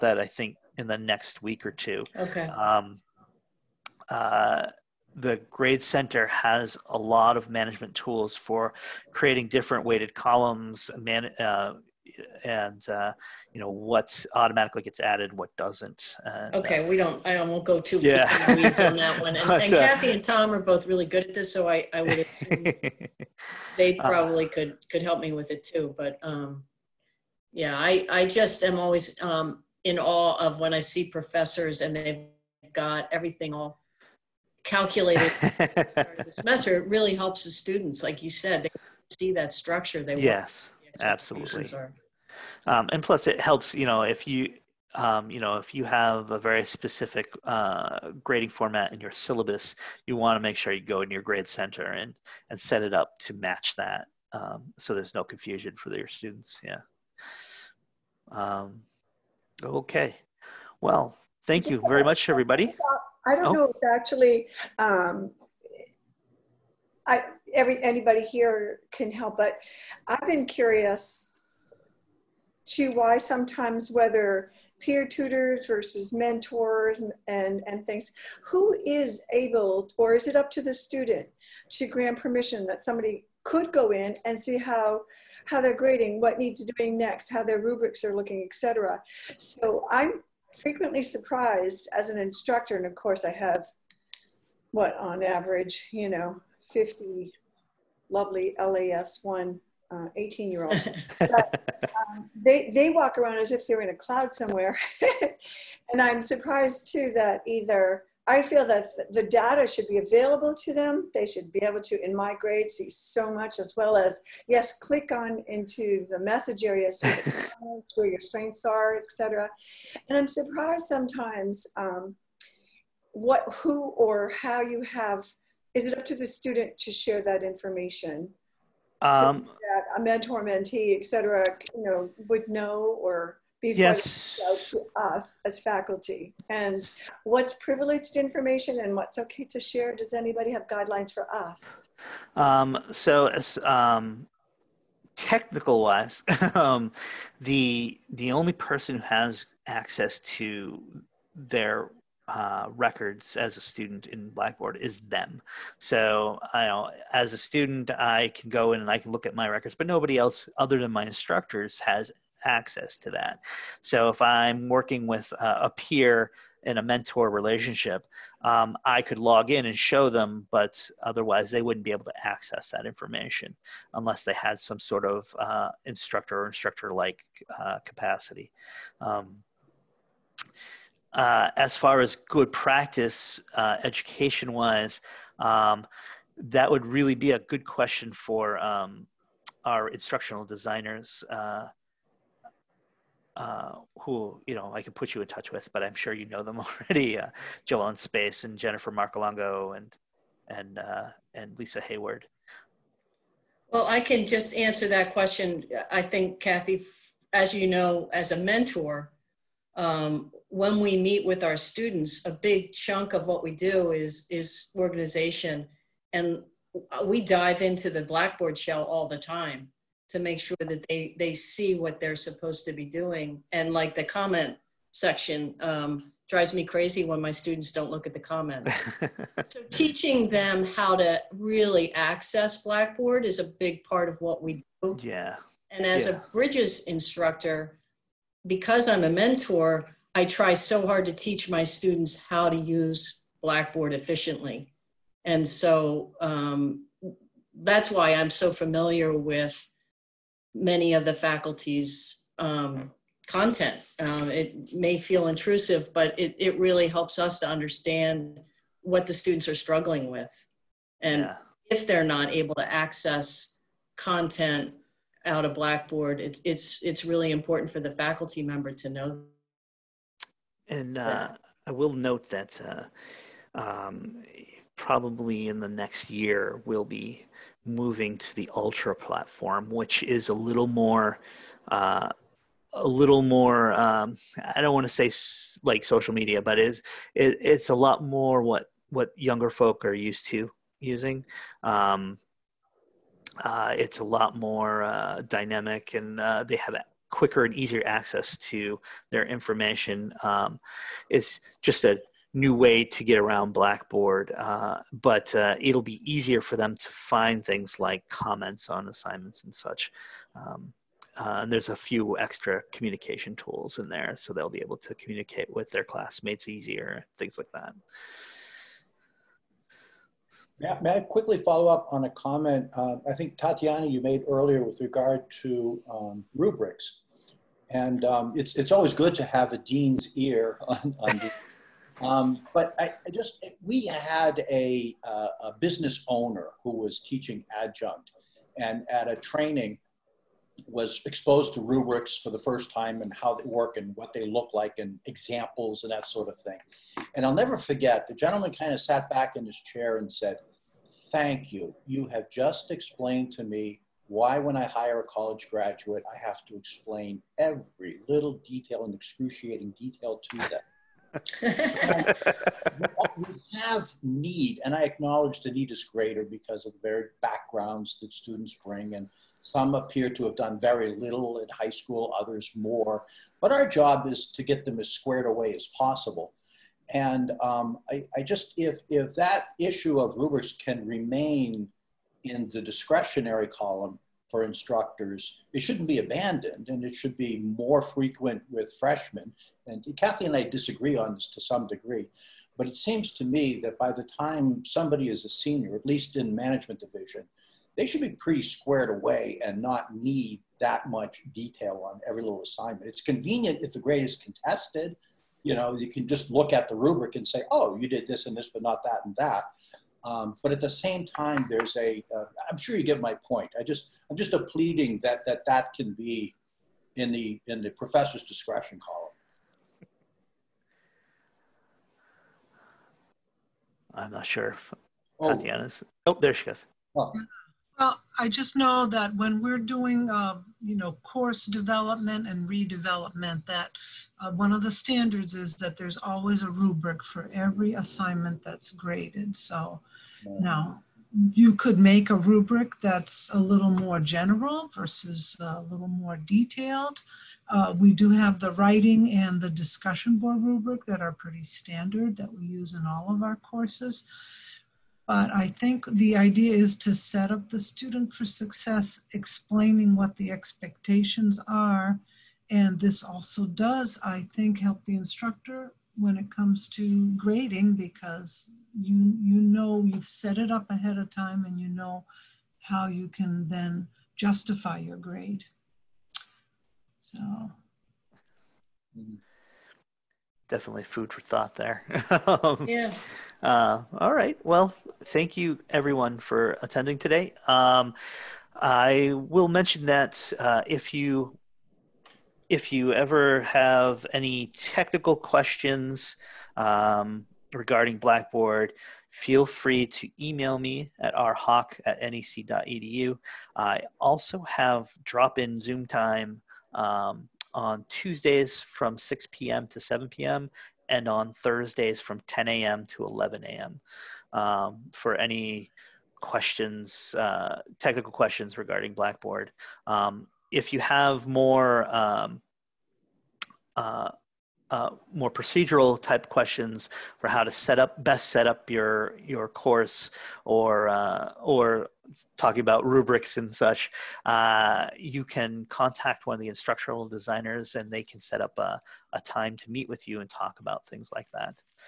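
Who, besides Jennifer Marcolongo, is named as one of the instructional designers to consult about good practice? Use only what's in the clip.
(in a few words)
Lisa Hayward.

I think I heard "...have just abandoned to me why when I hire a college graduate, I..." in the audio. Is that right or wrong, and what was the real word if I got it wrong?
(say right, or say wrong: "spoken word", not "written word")
wrong: "explained", not "abandoned".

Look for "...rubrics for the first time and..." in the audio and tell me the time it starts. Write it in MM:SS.
05:41.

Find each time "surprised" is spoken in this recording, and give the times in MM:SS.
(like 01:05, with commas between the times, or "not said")
01:31, 01:46, 02:00.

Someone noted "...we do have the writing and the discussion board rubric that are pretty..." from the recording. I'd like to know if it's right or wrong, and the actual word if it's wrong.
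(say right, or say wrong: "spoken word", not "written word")
right.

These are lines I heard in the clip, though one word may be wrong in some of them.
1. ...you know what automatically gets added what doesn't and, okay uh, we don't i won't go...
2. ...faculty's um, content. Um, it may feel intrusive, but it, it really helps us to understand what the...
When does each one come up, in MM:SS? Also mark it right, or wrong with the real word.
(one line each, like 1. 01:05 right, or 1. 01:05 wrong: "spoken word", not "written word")
1. 00:13 right
2. 04:11 right.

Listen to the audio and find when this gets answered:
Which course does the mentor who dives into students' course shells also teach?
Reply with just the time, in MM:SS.
03:56.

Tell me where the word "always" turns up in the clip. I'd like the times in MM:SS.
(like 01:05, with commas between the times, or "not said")
00:28, 05:28, 07:15.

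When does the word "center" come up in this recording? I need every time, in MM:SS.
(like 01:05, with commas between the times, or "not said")
00:05, 00:51.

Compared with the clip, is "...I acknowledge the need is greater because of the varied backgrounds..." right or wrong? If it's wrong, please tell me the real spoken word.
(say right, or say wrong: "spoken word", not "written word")
right.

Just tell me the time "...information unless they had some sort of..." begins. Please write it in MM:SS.
02:52.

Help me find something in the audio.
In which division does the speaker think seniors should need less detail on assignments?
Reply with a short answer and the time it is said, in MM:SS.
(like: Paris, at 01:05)
management division, at 06:36.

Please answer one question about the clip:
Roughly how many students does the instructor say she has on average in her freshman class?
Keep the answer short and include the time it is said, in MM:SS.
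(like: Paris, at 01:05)
50, at 01:36.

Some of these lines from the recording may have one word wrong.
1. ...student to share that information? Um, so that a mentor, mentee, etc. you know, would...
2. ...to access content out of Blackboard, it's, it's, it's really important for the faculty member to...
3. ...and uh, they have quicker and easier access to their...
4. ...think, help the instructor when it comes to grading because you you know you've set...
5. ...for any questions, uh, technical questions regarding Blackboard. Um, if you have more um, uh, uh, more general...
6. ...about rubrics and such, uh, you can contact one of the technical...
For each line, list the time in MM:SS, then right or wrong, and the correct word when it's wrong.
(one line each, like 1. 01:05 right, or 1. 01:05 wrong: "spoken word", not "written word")
1. 02:06 right
2. 04:22 right
3. 04:55 right
4. 07:44 right
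5. 08:34 wrong: "procedural", not "general"
6. 08:52 wrong: "instructional", not "technical".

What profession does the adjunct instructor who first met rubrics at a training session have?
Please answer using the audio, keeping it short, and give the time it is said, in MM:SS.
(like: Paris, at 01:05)
business owner, at 05:35.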